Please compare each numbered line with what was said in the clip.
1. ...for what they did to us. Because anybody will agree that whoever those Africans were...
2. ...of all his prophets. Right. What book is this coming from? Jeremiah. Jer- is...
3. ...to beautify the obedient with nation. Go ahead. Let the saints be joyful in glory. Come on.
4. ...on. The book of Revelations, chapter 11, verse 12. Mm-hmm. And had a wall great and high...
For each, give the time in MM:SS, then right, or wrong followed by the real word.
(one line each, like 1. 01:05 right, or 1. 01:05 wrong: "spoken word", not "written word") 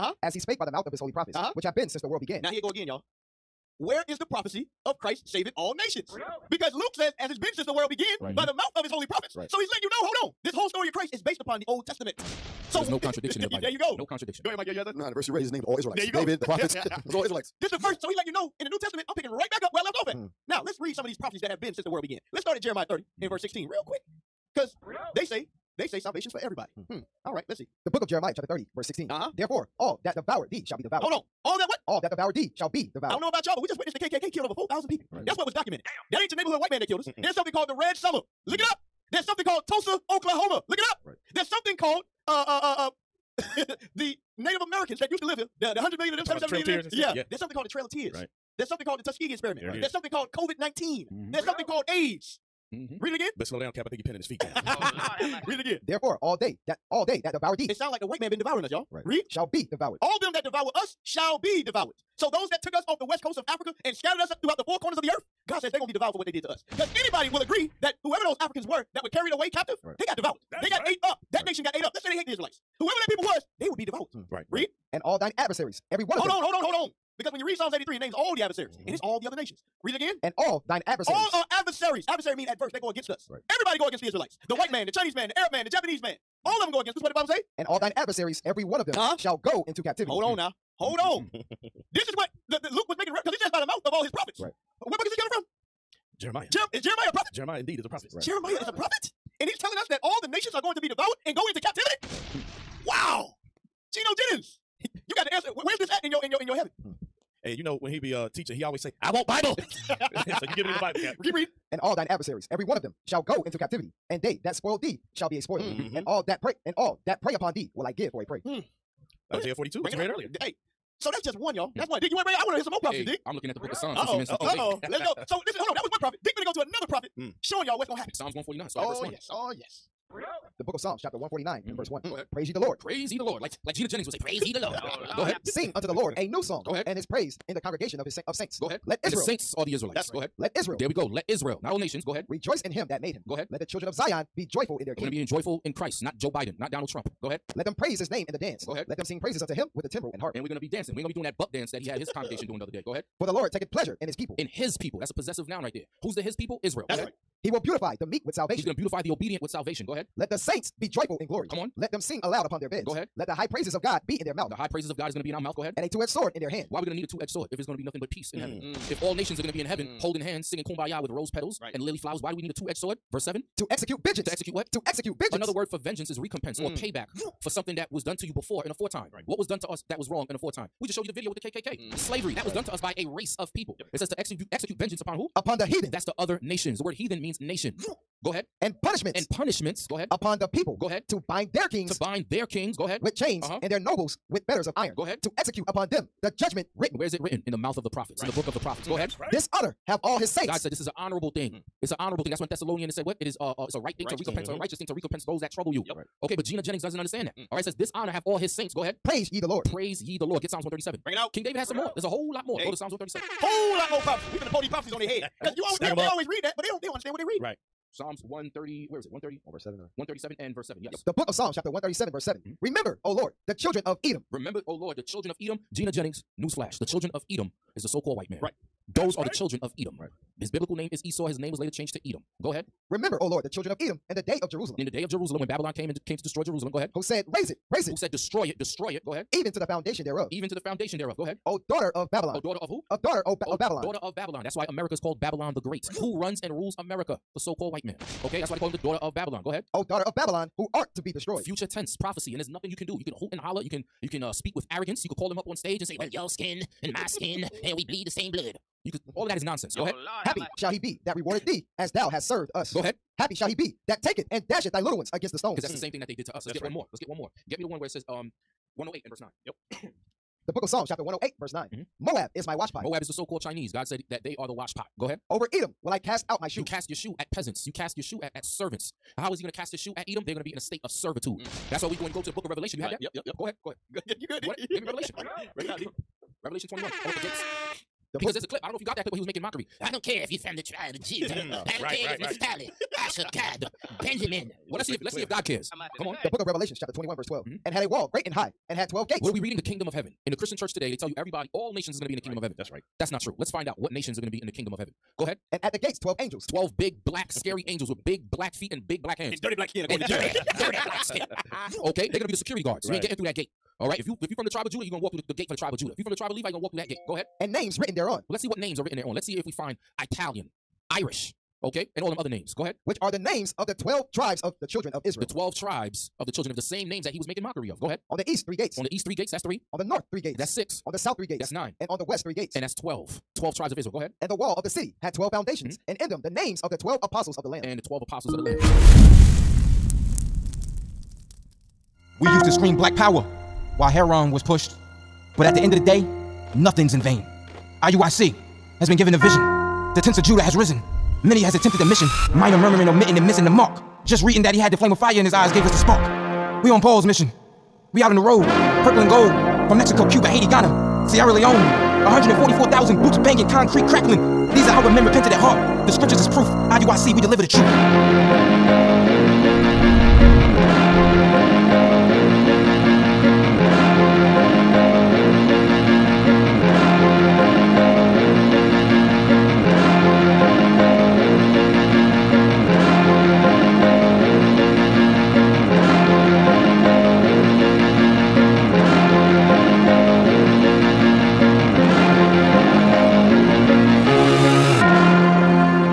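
1. 01:06 right
2. 01:33 right
3. 02:38 wrong: "salvation", not "nation"
4. 04:56 wrong: "21", not "11".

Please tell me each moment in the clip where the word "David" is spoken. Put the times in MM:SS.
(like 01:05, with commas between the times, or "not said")
00:16, 03:31.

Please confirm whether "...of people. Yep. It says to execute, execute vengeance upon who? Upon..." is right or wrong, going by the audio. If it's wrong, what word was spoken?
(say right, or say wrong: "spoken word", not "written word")
right.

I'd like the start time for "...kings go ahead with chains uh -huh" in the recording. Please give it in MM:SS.
03:12.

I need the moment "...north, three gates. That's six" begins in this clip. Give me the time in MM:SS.
05:29.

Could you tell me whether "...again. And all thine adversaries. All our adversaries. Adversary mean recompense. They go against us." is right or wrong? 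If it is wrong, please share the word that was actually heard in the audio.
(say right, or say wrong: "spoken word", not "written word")
wrong: "adverse", not "recompense".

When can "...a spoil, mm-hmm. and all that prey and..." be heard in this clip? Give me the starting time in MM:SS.
01:55.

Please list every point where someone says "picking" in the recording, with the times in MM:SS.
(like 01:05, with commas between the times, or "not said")
00:19.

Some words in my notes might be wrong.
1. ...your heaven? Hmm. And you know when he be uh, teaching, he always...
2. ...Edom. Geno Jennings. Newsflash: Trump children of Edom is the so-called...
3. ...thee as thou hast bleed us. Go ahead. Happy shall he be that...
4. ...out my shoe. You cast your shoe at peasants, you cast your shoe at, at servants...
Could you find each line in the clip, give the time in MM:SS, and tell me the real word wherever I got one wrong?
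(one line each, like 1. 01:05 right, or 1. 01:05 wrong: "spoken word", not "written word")
1. 01:46 right
2. 03:45 wrong: "The", not "Trump"
3. 04:21 wrong: "served", not "bleed"
4. 04:36 right.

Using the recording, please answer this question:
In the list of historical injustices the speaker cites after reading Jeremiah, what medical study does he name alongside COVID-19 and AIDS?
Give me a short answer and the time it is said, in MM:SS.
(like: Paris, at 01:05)
Tuskegee experiment, at 00:49.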